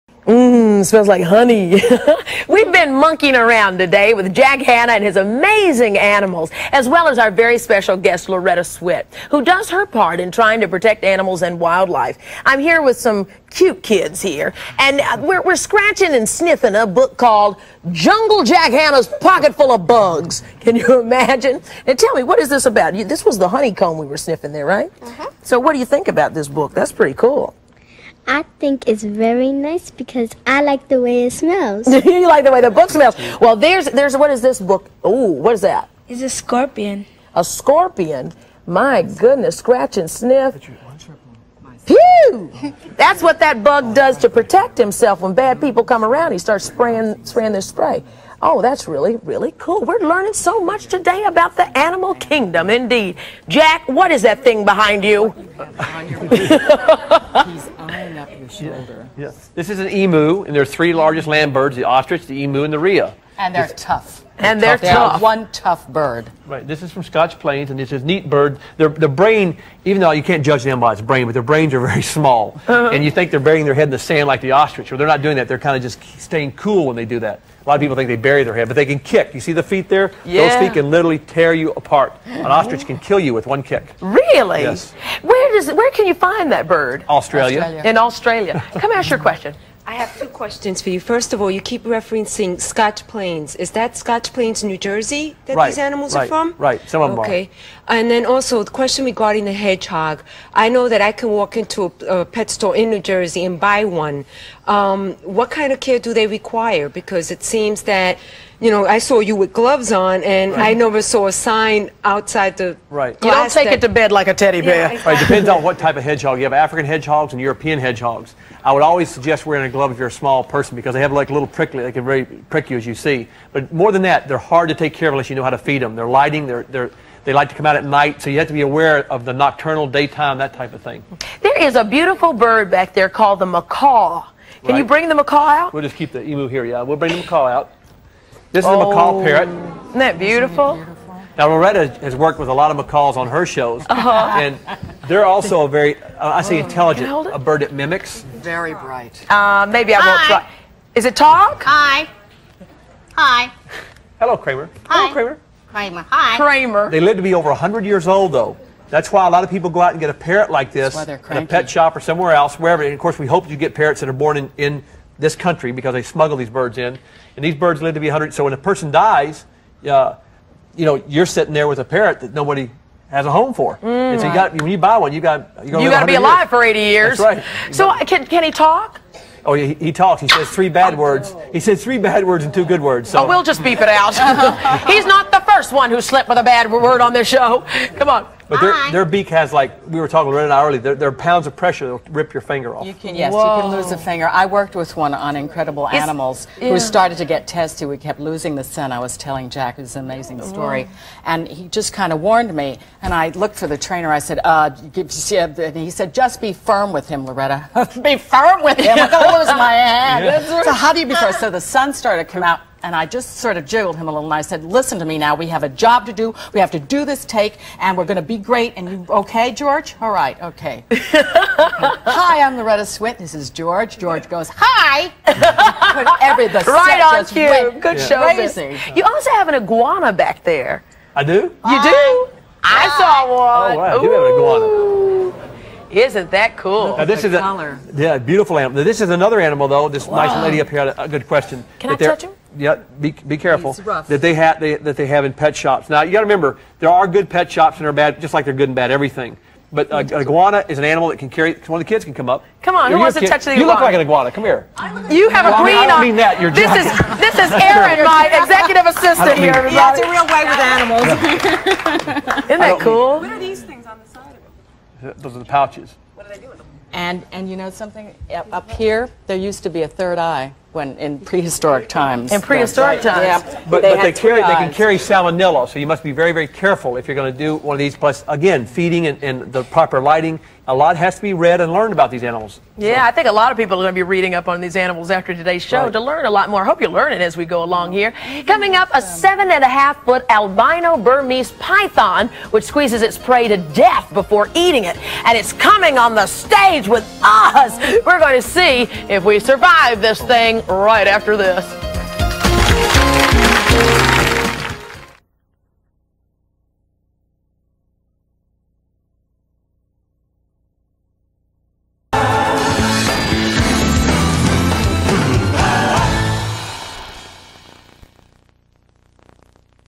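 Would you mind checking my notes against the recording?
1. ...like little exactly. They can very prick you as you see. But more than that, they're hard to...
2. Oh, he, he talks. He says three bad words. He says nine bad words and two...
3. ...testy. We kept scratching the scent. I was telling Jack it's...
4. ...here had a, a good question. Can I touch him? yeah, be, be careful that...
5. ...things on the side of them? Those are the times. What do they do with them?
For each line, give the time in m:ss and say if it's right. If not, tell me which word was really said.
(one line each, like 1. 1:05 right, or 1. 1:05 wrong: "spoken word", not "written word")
1. 2:01 wrong: "prickly", not "exactly"
2. 2:59 wrong: "three", not "nine"
3. 3:17 wrong: "losing", not "scratching"
4. 4:00 right
5. 4:23 wrong: "pouches", not "times".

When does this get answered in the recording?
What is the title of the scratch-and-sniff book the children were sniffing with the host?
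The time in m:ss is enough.
0:17.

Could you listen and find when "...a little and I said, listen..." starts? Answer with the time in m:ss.
3:34.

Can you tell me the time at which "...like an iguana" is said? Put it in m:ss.
4:13.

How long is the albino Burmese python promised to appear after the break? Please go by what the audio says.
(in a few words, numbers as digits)
7 and a half feet.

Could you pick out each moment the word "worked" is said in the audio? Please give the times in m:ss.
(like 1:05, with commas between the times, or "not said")
2:22, 3:14.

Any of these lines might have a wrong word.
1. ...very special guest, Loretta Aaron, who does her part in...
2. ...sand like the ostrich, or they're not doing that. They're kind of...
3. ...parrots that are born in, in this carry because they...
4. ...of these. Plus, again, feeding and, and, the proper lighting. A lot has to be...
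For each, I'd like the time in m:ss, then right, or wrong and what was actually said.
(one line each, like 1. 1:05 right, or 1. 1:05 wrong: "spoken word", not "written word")
1. 0:07 wrong: "Swit", not "Aaron"
2. 1:13 right
3. 2:43 wrong: "country", not "carry"
4. 4:37 right.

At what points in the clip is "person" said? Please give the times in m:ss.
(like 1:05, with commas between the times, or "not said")
2:00, 2:48.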